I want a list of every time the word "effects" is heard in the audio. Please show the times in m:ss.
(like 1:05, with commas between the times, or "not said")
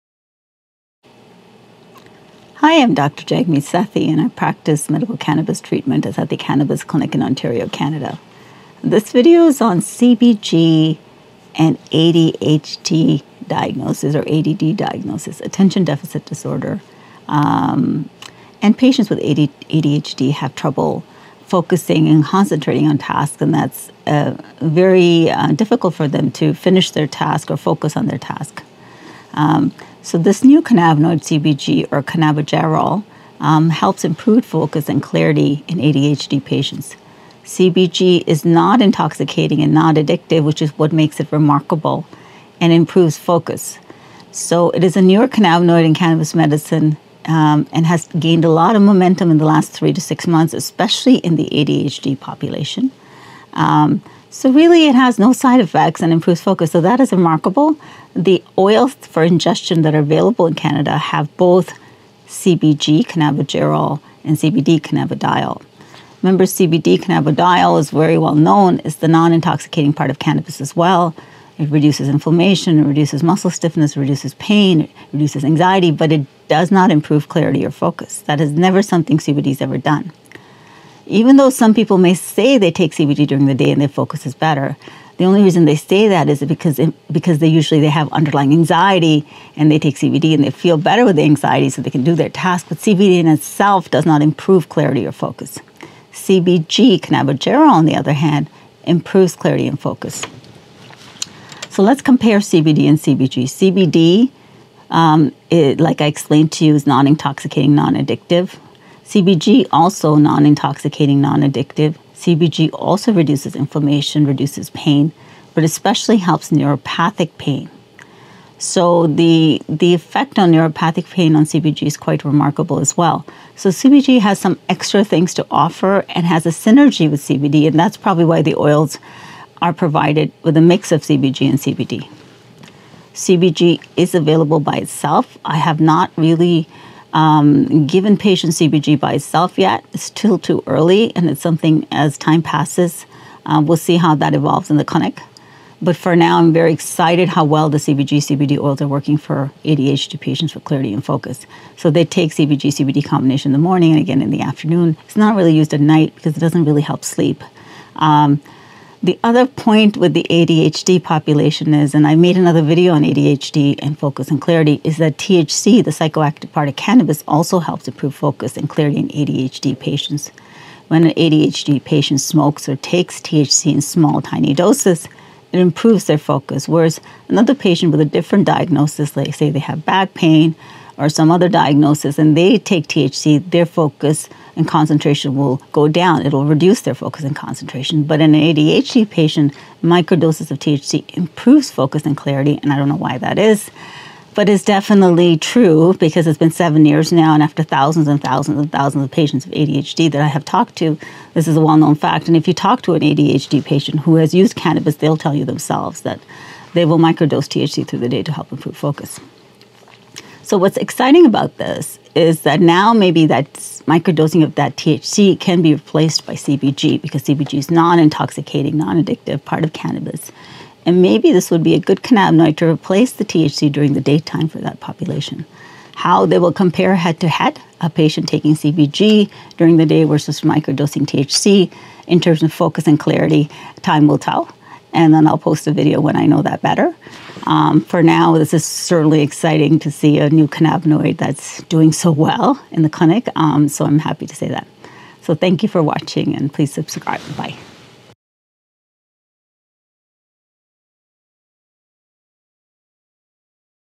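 0:55, 1:59.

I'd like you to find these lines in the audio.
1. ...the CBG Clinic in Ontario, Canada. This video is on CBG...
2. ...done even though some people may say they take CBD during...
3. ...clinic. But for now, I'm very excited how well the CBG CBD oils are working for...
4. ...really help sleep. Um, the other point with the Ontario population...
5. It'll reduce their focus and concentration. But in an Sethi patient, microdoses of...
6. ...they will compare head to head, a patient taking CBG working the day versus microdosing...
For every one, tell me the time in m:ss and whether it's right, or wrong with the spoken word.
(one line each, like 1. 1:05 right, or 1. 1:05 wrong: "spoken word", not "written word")
1. 0:06 wrong: "Cannabis", not "CBG"
2. 1:19 right
3. 2:24 right
4. 2:36 wrong: "ADHD", not "Ontario"
5. 3:06 wrong: "ADHD", not "Sethi"
6. 3:46 wrong: "during", not "working".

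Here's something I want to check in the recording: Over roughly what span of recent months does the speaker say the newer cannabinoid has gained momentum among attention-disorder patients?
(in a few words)
3 to 6 months.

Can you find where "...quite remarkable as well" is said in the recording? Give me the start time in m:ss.
2:01.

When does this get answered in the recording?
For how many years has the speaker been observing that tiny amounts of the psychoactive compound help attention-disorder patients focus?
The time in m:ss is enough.
3:16.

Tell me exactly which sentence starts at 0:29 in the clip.
Um, so this new cannabinoid CBG or cannabigerol um, helps improve focus and clarity in ADHD patients.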